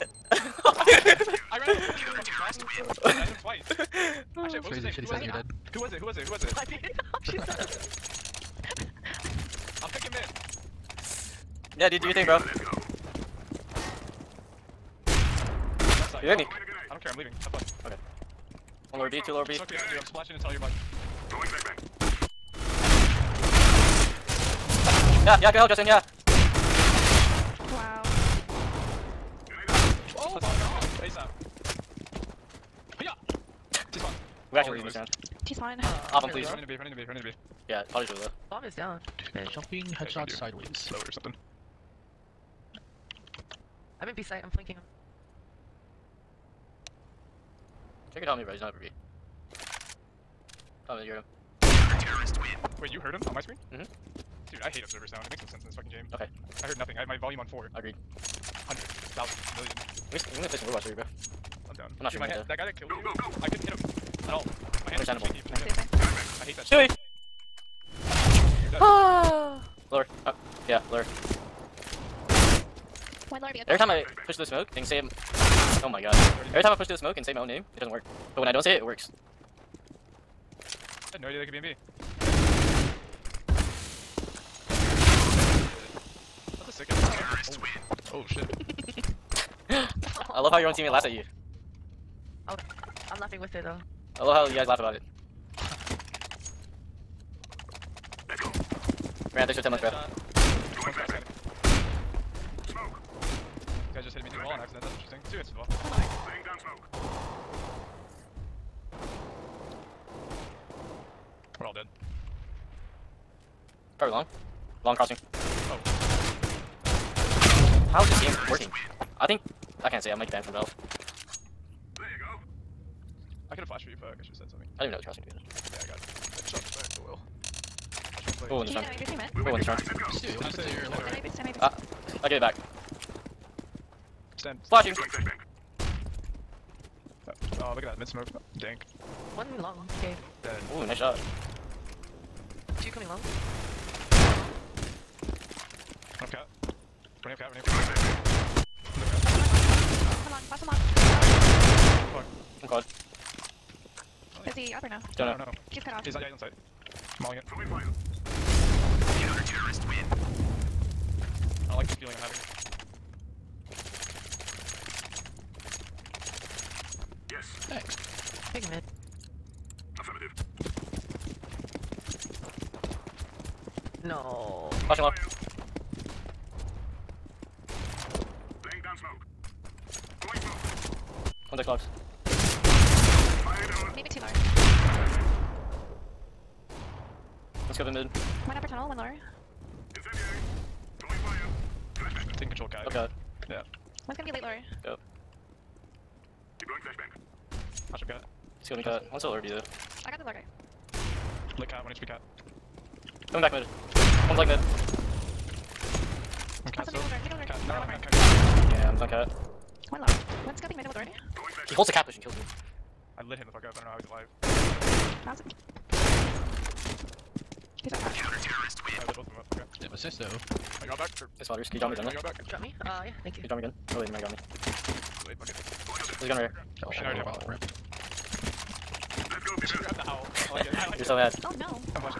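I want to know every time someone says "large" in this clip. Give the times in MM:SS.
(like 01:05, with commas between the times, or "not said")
03:04.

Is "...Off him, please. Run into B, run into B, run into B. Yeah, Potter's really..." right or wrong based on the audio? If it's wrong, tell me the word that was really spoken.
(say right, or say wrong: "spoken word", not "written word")
right.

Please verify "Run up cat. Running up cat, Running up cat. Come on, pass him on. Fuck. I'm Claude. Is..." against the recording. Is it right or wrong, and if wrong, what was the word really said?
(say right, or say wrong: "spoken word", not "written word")
right.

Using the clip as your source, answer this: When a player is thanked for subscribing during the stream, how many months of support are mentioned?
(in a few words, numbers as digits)
10 months.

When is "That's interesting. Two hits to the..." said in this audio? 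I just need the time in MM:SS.
01:44.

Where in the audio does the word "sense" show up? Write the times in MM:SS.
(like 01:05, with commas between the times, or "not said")
00:55.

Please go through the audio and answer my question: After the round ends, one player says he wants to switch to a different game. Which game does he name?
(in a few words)
Overwatch.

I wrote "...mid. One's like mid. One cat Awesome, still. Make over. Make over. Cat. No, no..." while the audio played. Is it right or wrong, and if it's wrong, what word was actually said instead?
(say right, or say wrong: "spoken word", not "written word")
right.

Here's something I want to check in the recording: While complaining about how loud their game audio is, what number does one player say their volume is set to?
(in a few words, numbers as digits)
4.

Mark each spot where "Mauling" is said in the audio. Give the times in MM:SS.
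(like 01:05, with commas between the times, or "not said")
02:37.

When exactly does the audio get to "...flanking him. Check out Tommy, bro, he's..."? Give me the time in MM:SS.
00:44.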